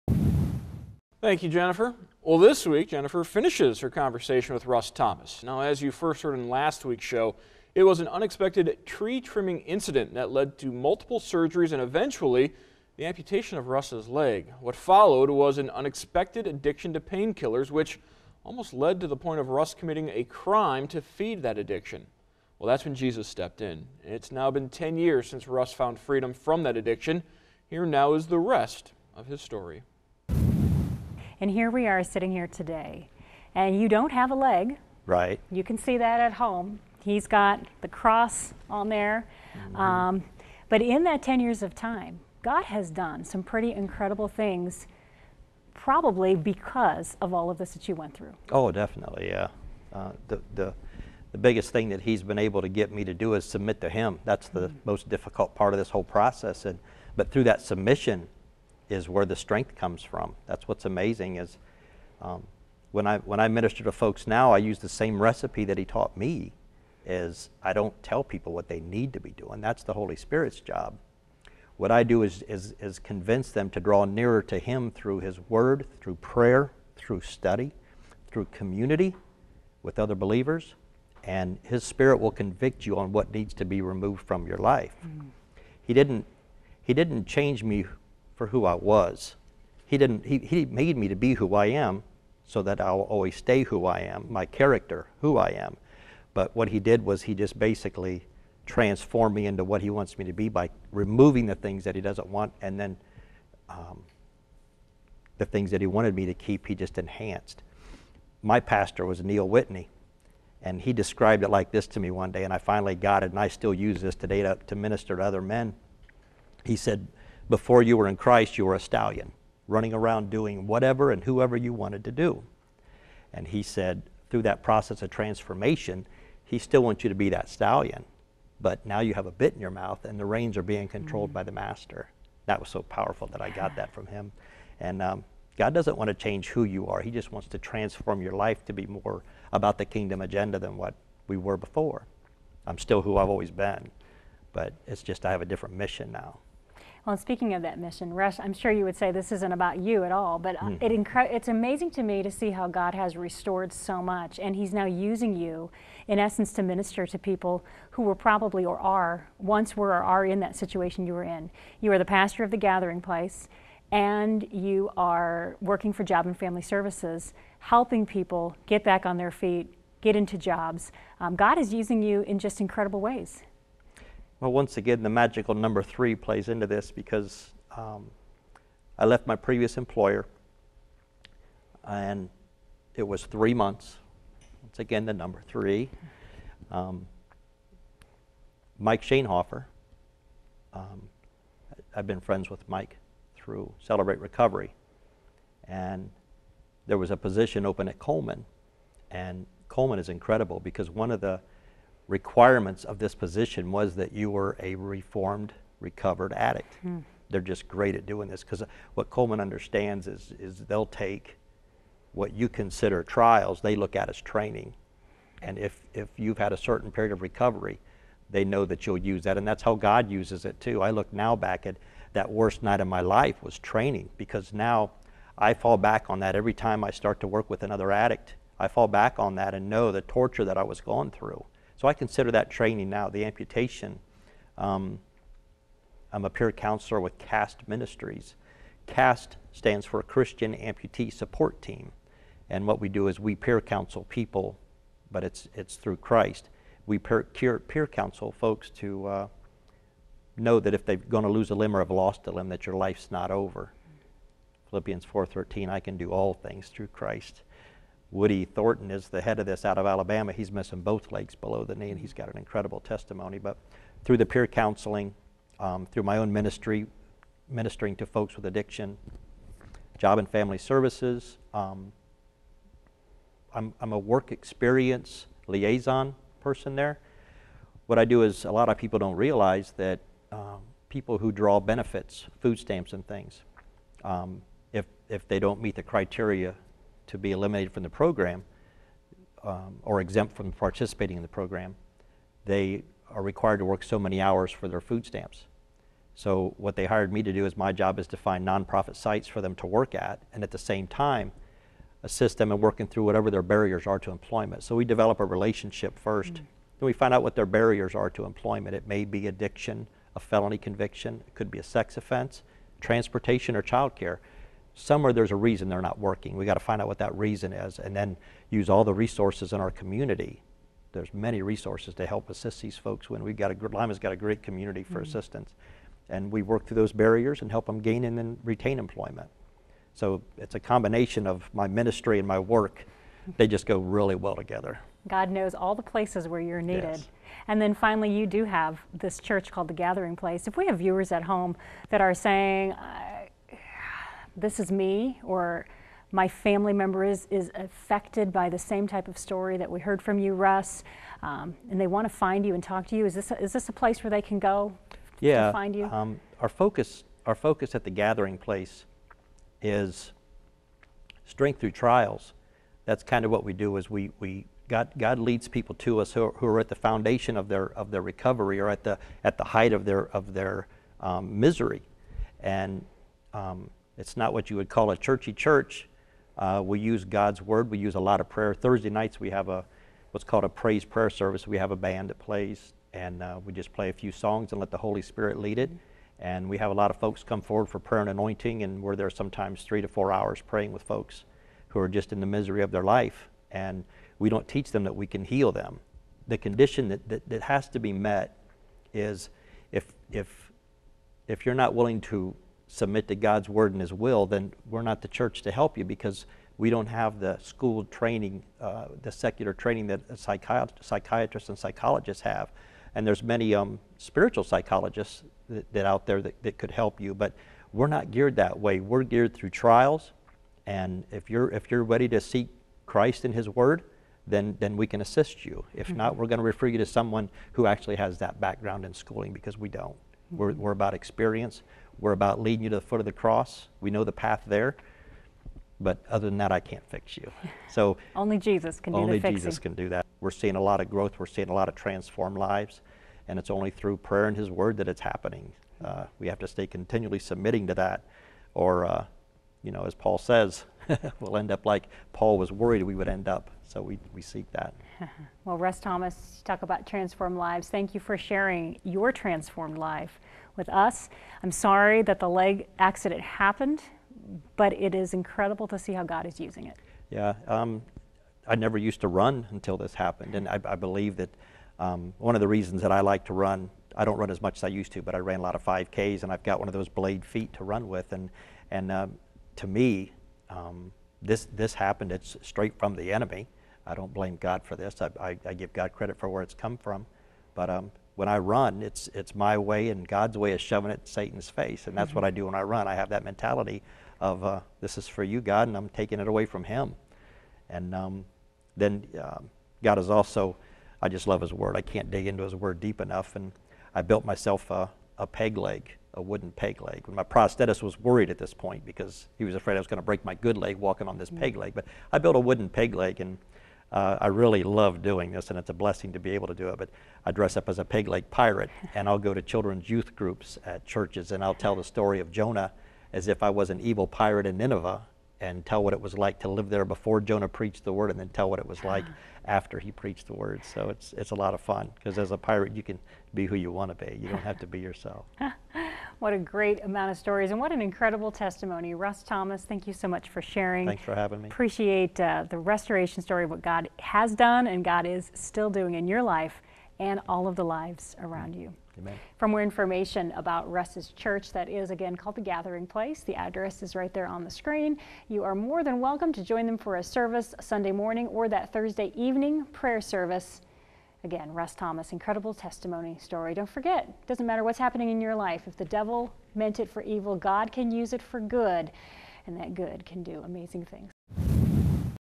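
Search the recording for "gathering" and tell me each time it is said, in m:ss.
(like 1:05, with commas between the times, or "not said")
2:42, 5:39, 5:57, 9:12.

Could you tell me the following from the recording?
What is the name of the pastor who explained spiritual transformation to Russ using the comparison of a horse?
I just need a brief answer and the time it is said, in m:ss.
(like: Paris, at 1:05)
Neil Whitney, at 1:49.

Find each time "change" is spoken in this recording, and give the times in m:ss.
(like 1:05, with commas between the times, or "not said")
1:27, 2:16.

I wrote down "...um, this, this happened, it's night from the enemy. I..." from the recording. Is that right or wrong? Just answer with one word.
wrong.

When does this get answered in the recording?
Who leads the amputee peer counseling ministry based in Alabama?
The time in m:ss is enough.
4:18.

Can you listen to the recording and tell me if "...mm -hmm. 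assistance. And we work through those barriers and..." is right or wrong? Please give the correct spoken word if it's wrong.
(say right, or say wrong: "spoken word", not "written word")
right.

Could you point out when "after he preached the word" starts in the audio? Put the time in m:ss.
8:49.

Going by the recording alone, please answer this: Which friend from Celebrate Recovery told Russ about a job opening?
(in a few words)
Mike Shanehofer.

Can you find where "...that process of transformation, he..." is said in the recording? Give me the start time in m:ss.
2:04.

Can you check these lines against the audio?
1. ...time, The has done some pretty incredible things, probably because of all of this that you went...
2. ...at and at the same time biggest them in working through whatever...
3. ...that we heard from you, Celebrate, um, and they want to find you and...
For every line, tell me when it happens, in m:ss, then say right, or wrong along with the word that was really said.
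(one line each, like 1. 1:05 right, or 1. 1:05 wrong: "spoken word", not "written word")
1. 0:41 wrong: "God", not "The"
2. 4:59 wrong: "assist", not "biggest"
3. 5:49 wrong: "Russ", not "Celebrate".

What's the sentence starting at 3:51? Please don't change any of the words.
So I consider that training now, the amputation.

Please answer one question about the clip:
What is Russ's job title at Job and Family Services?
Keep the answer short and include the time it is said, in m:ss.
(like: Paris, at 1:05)
Work experience liaison, at 4:33.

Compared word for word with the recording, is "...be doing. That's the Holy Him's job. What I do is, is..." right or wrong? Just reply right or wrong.
wrong.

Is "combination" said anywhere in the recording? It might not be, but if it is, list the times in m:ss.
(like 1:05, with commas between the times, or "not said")
5:30.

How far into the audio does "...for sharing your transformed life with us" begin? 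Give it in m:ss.
7:37.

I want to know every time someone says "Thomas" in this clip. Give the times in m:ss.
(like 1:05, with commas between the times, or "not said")
0:04, 7:35, 8:59, 9:21.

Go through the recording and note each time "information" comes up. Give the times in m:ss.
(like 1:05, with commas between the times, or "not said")
9:09.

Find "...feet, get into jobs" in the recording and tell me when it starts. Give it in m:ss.
2:49.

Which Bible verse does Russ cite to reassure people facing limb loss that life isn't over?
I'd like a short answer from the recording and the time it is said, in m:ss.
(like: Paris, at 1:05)
Philippians 4:13, at 4:14.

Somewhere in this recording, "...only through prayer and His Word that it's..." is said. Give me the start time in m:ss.
7:23.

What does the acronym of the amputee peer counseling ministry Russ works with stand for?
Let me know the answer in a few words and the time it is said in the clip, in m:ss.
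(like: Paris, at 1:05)
Christian Amputee Support Team, at 4:00.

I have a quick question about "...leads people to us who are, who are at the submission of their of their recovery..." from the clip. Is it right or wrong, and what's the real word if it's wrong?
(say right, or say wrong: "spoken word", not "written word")
wrong: "foundation", not "submission".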